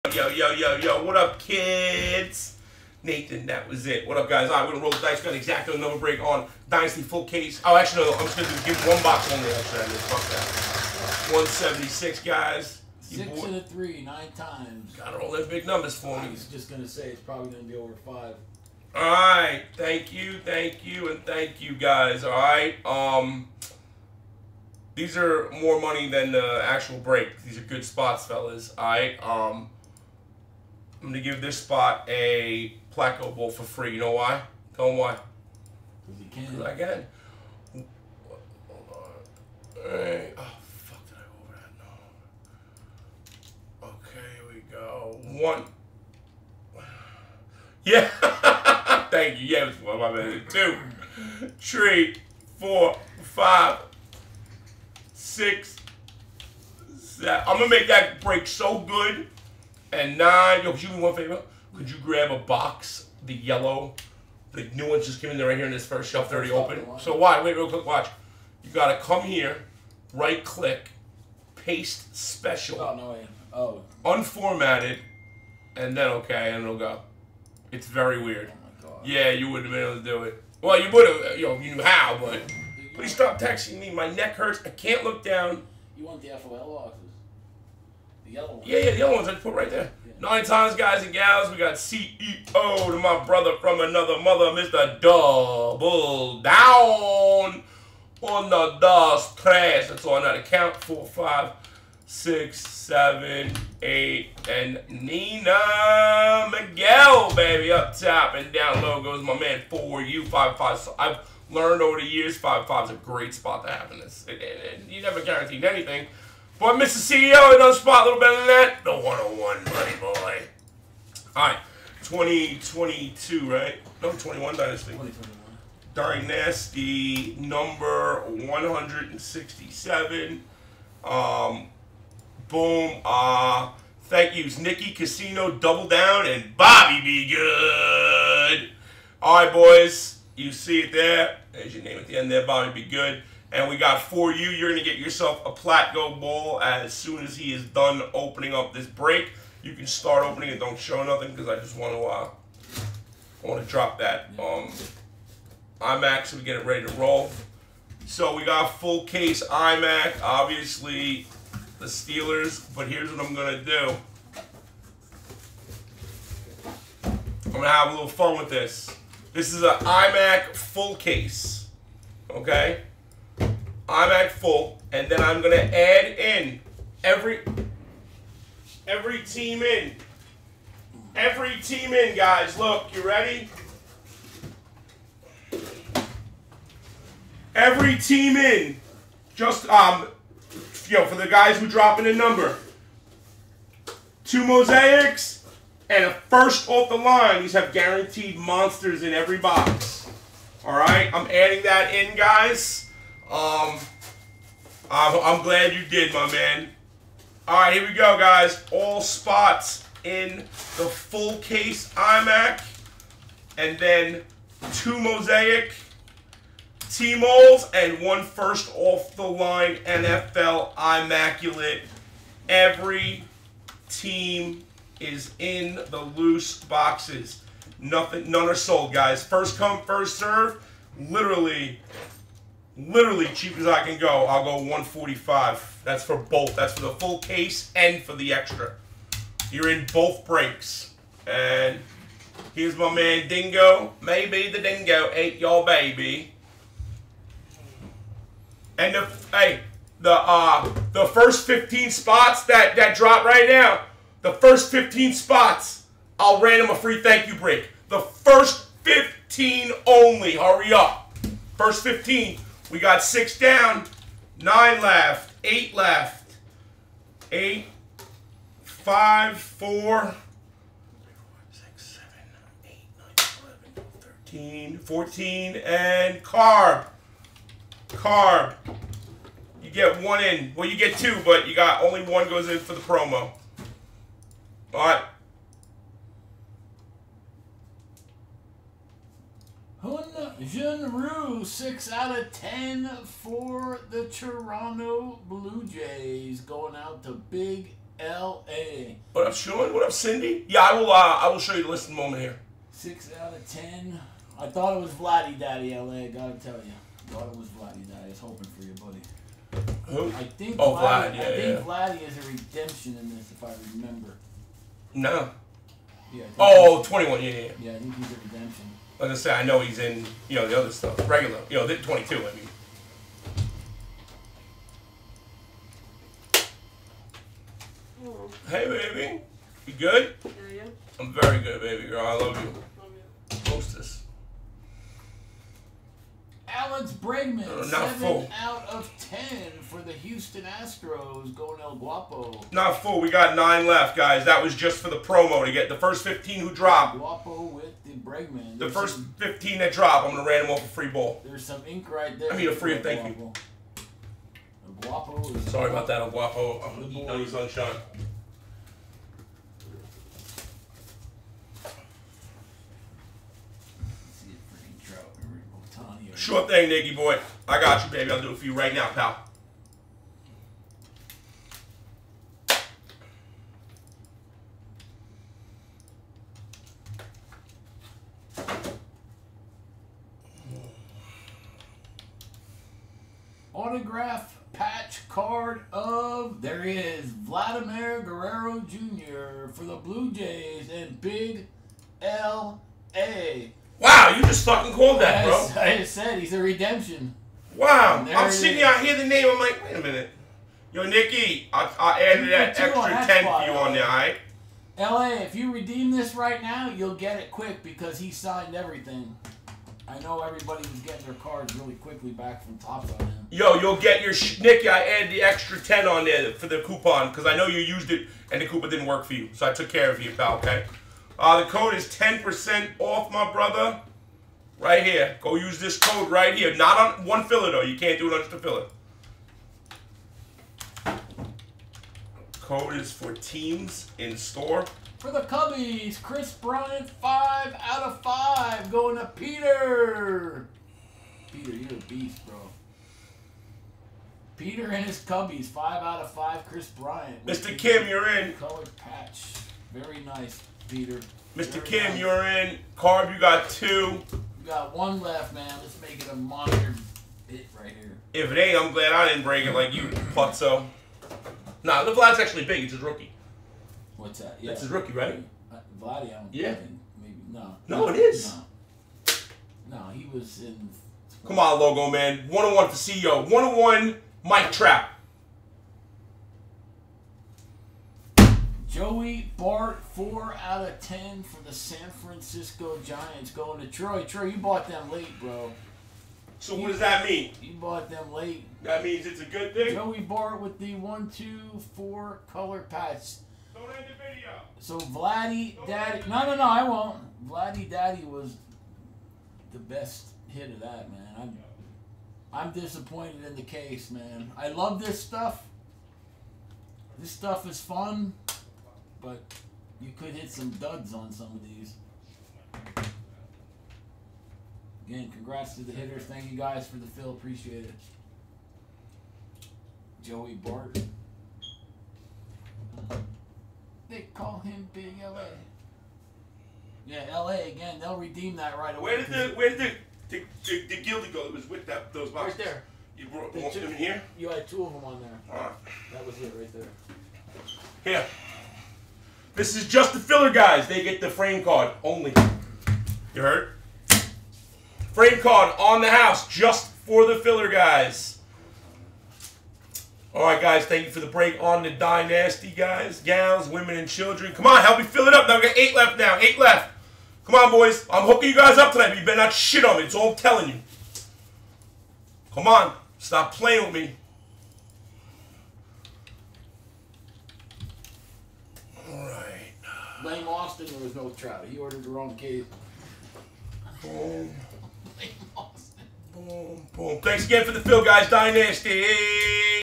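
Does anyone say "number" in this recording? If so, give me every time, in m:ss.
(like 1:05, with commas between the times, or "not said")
0:05, 0:15, 2:07, 3:12.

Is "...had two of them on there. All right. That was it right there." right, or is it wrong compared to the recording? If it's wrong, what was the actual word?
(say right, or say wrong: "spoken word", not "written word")
right.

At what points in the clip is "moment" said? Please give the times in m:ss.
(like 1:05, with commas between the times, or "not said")
5:01.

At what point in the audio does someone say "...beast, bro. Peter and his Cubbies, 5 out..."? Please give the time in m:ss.
7:21.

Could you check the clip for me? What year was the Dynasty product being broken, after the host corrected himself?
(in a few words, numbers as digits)
2021.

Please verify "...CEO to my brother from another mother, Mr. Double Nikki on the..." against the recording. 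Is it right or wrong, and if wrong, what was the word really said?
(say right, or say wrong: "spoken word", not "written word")
wrong: "Down", not "Nikki".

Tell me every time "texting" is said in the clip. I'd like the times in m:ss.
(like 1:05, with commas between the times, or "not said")
1:23.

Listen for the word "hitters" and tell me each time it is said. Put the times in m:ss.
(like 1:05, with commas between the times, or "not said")
8:35.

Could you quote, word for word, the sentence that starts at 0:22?
Um, These are more money than the actual break.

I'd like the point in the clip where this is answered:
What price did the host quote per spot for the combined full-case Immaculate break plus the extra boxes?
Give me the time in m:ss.
3:54.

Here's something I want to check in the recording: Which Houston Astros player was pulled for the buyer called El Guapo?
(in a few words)
Alex Bregman.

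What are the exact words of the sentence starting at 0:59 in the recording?
And nine, yo, could you do me one favor?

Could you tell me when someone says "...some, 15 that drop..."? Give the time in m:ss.
5:48.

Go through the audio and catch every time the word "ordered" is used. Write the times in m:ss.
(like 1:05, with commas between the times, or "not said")
9:31.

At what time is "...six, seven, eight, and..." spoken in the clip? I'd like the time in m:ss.
1:42.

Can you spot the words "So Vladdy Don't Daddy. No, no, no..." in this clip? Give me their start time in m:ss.
8:14.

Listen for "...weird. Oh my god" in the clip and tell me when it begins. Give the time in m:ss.
1:18.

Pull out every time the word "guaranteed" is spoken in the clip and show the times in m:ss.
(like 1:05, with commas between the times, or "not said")
1:55, 3:17.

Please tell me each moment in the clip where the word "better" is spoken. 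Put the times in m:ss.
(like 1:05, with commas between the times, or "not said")
1:58, 9:19.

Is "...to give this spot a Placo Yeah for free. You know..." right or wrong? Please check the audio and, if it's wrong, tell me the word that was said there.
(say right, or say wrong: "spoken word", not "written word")
wrong: "Bowl", not "Yeah".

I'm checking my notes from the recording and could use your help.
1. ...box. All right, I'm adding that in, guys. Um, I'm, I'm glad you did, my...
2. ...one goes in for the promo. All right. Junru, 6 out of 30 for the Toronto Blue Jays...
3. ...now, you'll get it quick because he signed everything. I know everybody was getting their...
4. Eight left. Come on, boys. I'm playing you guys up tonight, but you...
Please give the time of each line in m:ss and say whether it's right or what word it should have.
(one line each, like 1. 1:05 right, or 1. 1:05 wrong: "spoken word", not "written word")
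1. 3:19 right
2. 4:42 wrong: "10", not "30"
3. 6:46 right
4. 9:16 wrong: "hooking", not "playing".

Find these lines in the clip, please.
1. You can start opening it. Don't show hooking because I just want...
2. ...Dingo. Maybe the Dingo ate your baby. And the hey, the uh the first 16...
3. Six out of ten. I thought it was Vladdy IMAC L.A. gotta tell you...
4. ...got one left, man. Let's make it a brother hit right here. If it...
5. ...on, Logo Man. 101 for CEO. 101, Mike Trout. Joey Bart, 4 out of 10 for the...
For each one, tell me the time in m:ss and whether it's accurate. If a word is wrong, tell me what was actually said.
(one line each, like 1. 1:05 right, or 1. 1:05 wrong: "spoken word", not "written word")
1. 2:29 wrong: "nothing", not "hooking"
2. 4:03 wrong: "15", not "16"
3. 5:02 wrong: "Daddy", not "IMAC"
4. 7:34 wrong: "monster", not "brother"
5. 7:51 right.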